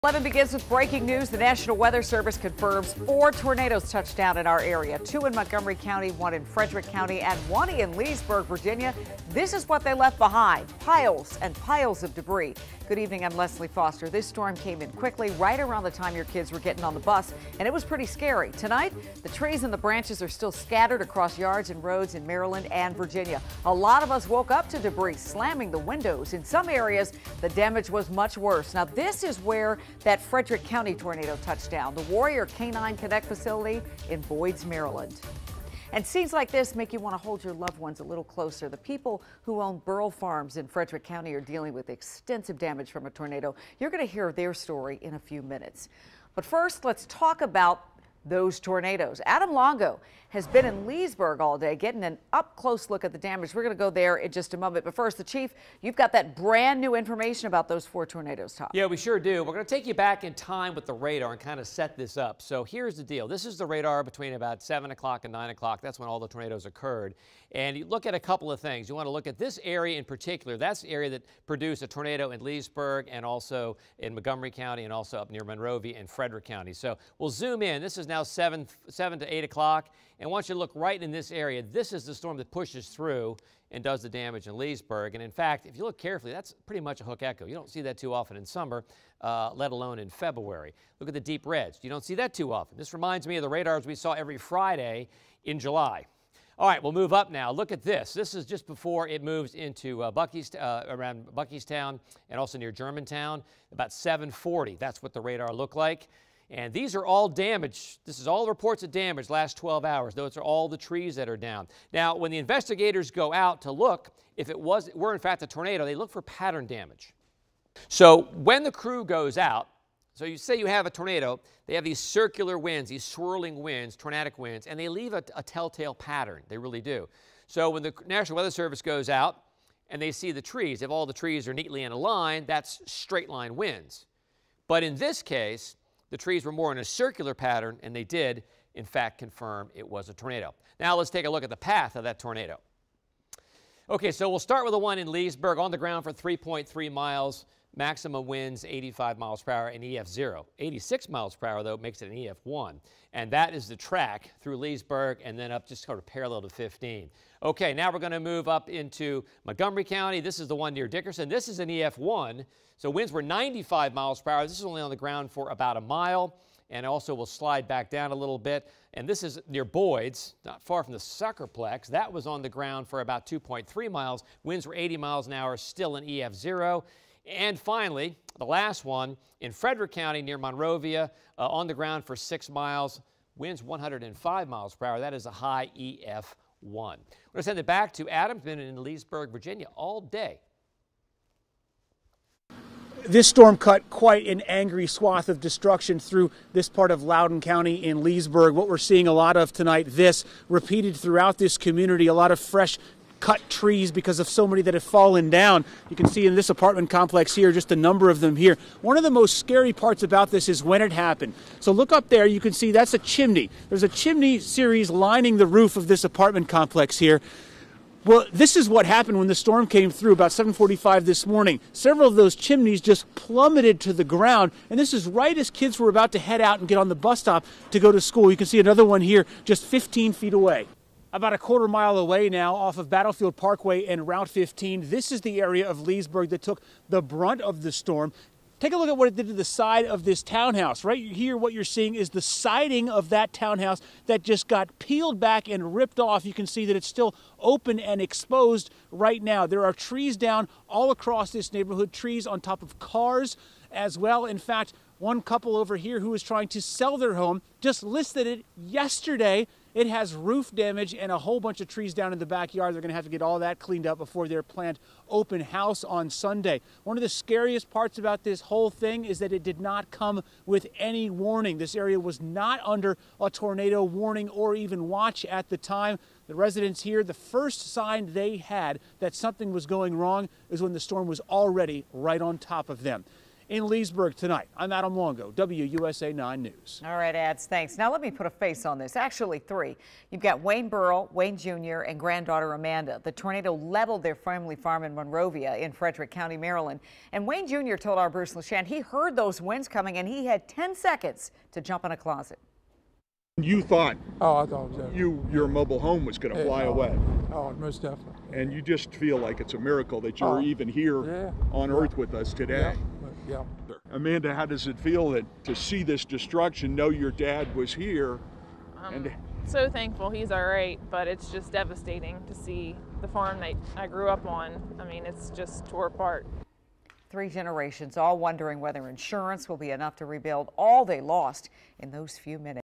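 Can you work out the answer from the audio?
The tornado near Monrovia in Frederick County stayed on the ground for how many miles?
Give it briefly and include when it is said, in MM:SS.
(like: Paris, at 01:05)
6 miles, at 03:02.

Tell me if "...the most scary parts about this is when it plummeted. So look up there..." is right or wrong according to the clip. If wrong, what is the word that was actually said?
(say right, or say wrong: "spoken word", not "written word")
wrong: "happened", not "plummeted".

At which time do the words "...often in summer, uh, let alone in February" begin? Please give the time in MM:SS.
01:28.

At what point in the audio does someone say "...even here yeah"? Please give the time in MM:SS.
05:10.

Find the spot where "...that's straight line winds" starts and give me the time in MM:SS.
02:12.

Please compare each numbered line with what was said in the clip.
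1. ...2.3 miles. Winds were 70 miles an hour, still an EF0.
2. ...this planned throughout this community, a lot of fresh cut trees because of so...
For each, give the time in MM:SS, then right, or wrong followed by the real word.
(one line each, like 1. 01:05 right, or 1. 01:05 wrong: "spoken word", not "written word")
1. 02:53 wrong: "80", not "70"
2. 03:19 wrong: "repeated", not "planned".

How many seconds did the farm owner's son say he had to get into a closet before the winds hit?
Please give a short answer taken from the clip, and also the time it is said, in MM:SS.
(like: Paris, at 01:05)
10 seconds, at 05:00.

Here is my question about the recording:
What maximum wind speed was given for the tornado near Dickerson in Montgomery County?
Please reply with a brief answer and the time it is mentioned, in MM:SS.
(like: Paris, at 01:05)
95 mph, at 02:43.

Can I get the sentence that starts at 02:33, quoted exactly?
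And that is the track through Leesburg and then up just sort of parallel to 15.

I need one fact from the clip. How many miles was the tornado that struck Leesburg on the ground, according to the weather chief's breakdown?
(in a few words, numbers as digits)
3.3 miles.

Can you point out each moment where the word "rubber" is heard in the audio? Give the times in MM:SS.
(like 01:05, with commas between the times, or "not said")
not said.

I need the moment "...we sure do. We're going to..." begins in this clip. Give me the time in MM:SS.
00:58.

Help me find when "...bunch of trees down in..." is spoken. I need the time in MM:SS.
04:21.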